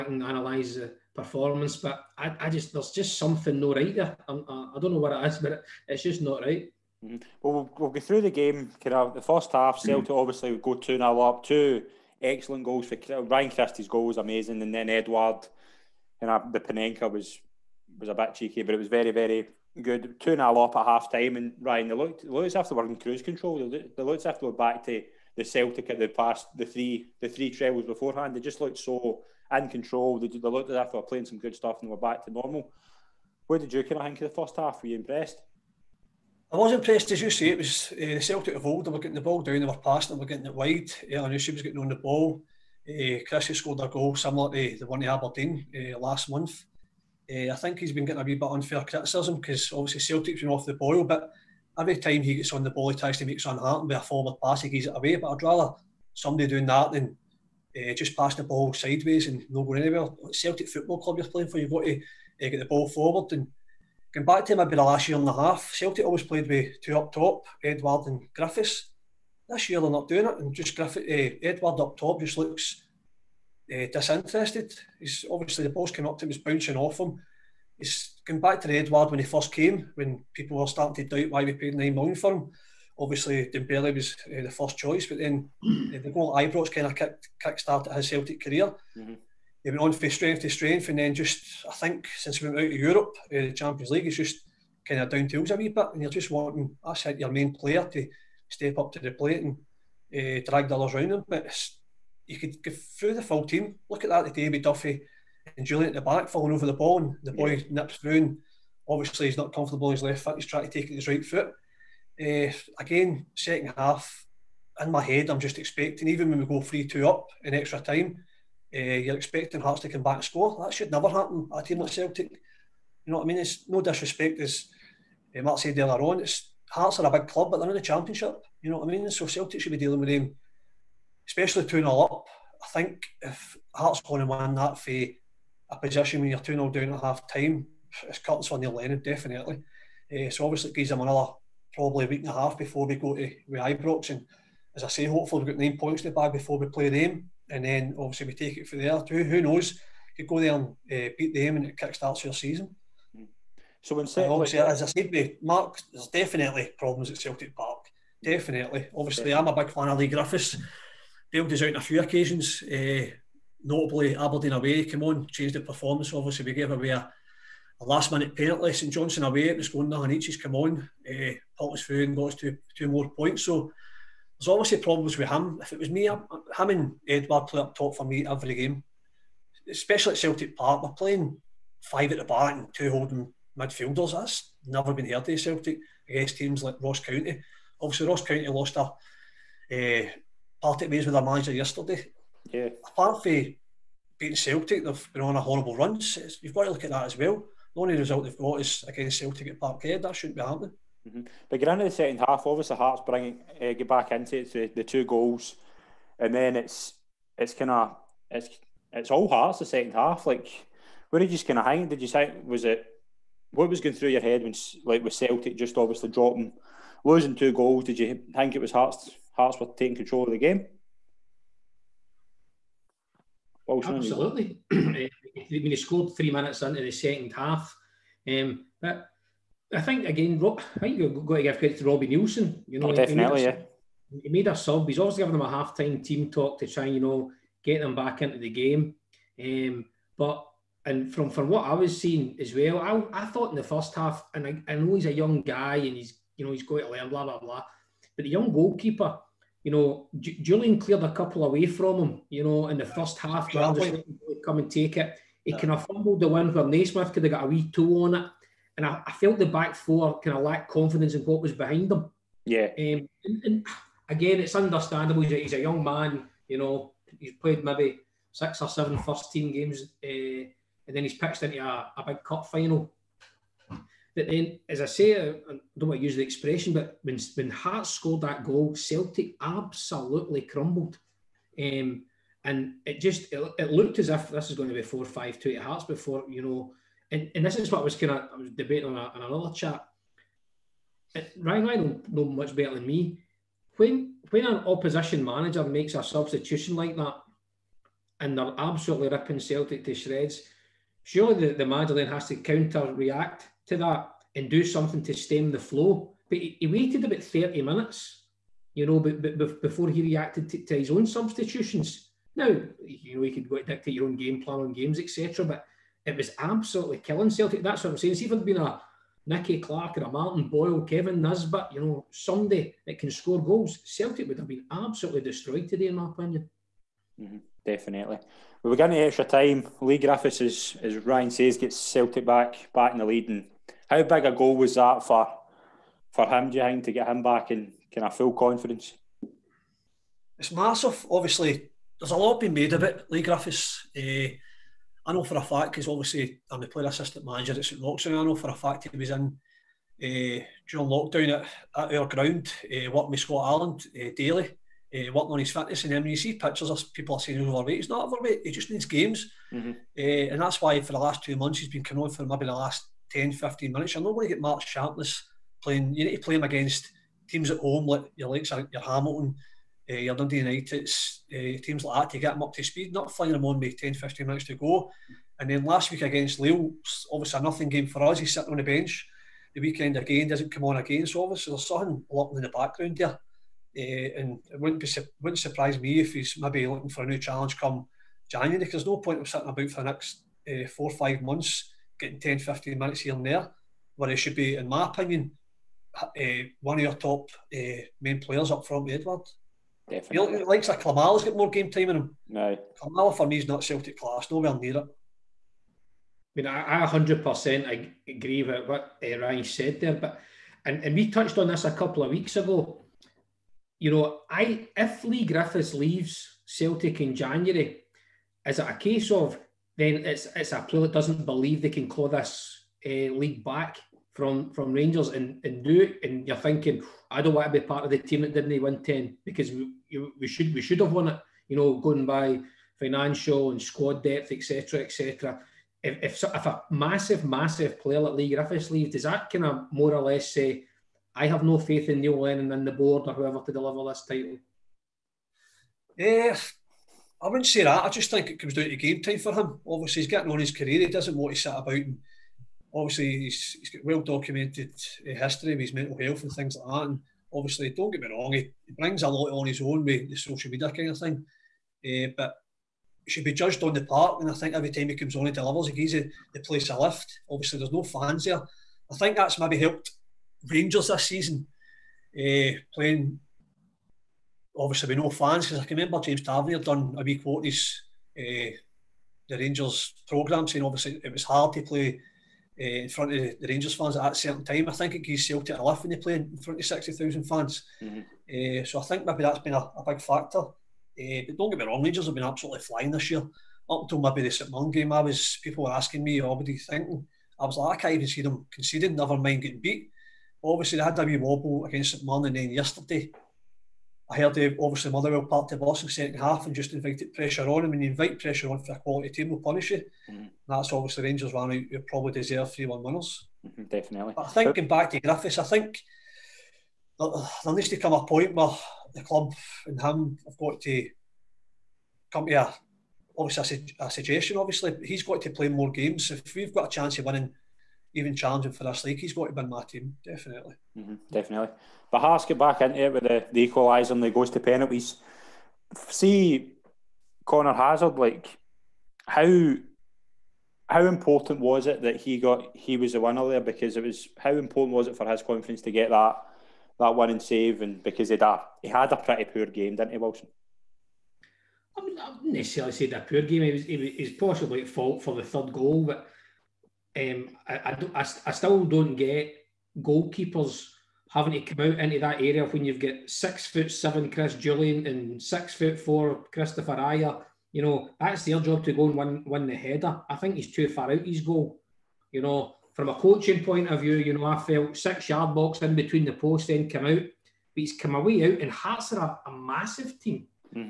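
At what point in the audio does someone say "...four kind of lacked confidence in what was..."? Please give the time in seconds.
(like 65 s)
259 s.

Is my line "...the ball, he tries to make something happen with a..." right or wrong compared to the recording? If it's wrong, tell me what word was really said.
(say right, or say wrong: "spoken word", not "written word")
right.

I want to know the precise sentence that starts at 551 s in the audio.
I wouldn't necessarily say that poor game.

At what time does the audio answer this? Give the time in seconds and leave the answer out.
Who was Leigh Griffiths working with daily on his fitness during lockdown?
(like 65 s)
353 s.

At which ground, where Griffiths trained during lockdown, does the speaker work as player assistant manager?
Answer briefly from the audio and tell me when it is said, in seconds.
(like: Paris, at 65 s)
St Roxon, at 347 s.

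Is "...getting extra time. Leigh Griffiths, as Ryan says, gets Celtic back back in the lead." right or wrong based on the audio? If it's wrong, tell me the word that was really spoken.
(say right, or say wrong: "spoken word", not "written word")
right.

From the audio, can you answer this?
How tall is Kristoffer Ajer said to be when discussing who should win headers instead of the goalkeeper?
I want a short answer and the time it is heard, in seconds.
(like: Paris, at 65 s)
6 foot 4, at 565 s.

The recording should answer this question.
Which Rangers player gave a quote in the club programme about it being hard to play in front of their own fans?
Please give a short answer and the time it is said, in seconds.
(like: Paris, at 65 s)
James Tavernier, at 475 s.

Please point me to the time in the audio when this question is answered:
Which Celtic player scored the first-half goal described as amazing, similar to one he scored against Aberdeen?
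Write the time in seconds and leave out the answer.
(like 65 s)
13 s.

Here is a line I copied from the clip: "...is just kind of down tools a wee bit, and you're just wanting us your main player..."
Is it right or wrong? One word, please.
right.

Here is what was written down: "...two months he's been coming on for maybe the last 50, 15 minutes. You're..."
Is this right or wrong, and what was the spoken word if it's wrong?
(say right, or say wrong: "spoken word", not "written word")
wrong: "10", not "50".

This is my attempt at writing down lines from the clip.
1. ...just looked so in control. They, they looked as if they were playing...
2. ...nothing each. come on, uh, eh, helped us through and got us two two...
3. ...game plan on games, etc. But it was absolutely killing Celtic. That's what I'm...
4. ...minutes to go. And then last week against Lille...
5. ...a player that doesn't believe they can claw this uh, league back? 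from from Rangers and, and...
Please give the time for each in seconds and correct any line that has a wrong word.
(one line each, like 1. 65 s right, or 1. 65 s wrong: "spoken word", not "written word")
1. 28 s right
2. 169 s right
3. 314 s right
4. 374 s right
5. 420 s right.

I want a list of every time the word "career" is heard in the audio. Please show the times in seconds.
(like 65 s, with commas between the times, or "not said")
88 s, 450 s.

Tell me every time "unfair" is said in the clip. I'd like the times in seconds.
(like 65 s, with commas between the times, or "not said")
48 s.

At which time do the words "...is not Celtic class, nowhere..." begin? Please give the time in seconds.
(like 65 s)
403 s.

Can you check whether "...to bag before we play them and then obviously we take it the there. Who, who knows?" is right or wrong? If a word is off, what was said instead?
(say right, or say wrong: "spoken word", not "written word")
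right.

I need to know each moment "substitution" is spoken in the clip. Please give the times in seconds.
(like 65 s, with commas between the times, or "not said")
296 s, 311 s.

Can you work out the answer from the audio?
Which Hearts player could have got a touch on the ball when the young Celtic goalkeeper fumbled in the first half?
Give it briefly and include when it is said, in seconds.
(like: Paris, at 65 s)
Naismith, at 256 s.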